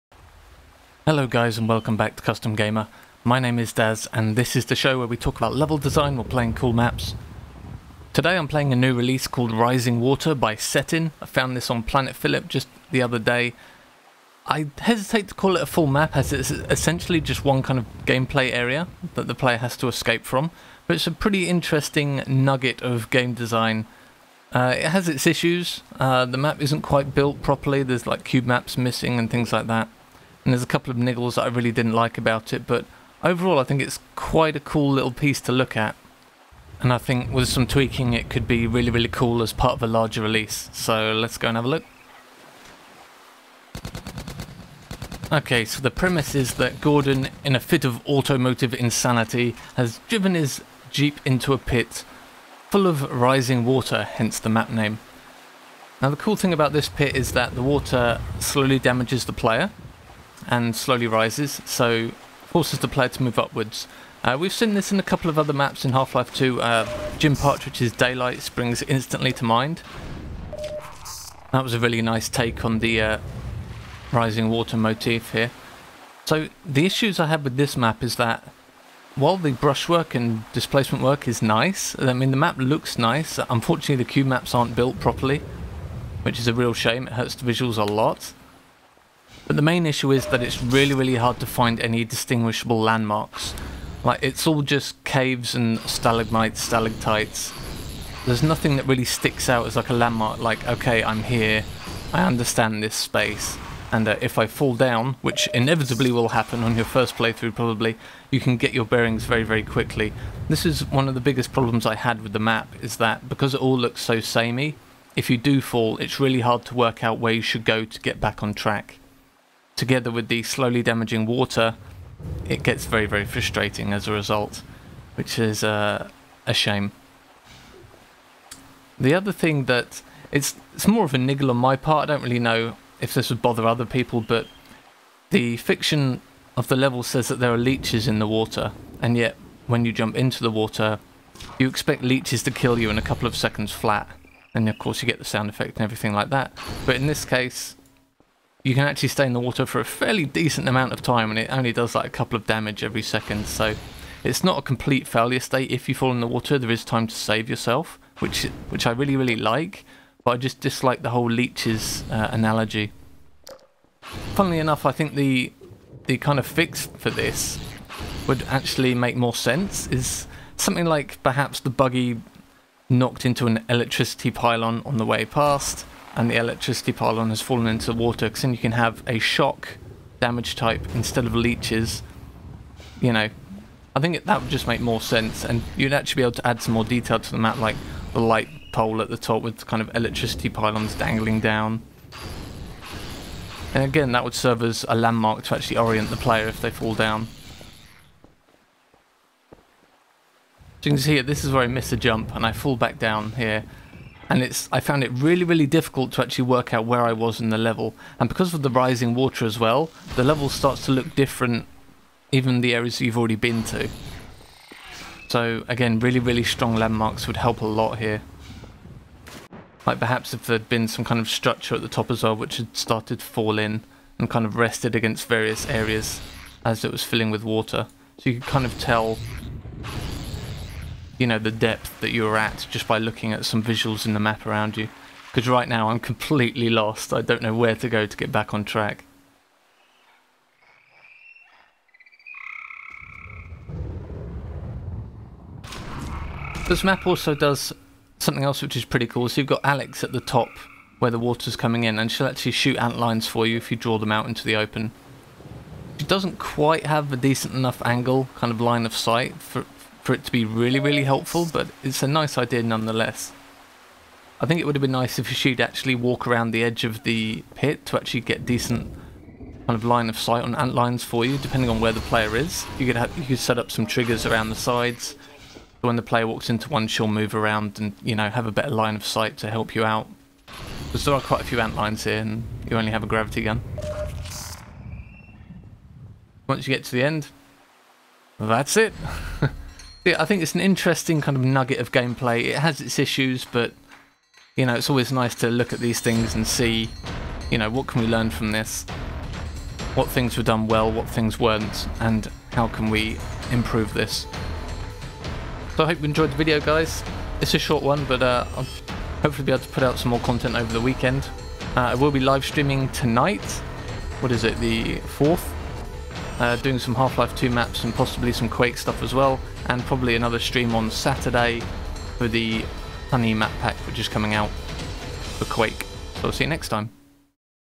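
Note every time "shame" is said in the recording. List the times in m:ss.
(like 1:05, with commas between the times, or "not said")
1:26, 2:06.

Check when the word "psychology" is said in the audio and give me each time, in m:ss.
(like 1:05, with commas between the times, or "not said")
not said.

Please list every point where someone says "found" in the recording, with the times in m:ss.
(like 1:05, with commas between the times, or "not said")
0:11, 3:24.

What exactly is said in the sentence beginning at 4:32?
You could have you could set up some triggers around the sides.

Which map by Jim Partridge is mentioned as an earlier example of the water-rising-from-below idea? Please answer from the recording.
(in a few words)
Daylight.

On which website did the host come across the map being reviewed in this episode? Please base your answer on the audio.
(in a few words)
Planet Phillip.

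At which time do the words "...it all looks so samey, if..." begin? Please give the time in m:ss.
1:53.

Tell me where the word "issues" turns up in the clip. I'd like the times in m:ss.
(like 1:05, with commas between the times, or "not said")
0:25, 1:16, 1:29, 4:52.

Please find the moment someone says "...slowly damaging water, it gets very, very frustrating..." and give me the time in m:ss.
2:00.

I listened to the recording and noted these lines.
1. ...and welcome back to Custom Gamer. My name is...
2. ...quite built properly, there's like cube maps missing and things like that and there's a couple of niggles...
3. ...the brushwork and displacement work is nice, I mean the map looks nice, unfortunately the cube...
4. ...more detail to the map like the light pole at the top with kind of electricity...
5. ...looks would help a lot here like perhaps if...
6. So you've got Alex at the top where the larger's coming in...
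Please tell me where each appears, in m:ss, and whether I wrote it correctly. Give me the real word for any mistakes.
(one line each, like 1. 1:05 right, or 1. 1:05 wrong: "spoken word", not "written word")
1. 0:01 right
2. 0:26 right
3. 1:19 right
4. 3:06 right
5. 3:36 wrong: "landmarks", not "looks"
6. 4:09 wrong: "water", not "larger".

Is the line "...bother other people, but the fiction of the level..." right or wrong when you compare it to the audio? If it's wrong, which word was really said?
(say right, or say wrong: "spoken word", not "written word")
right.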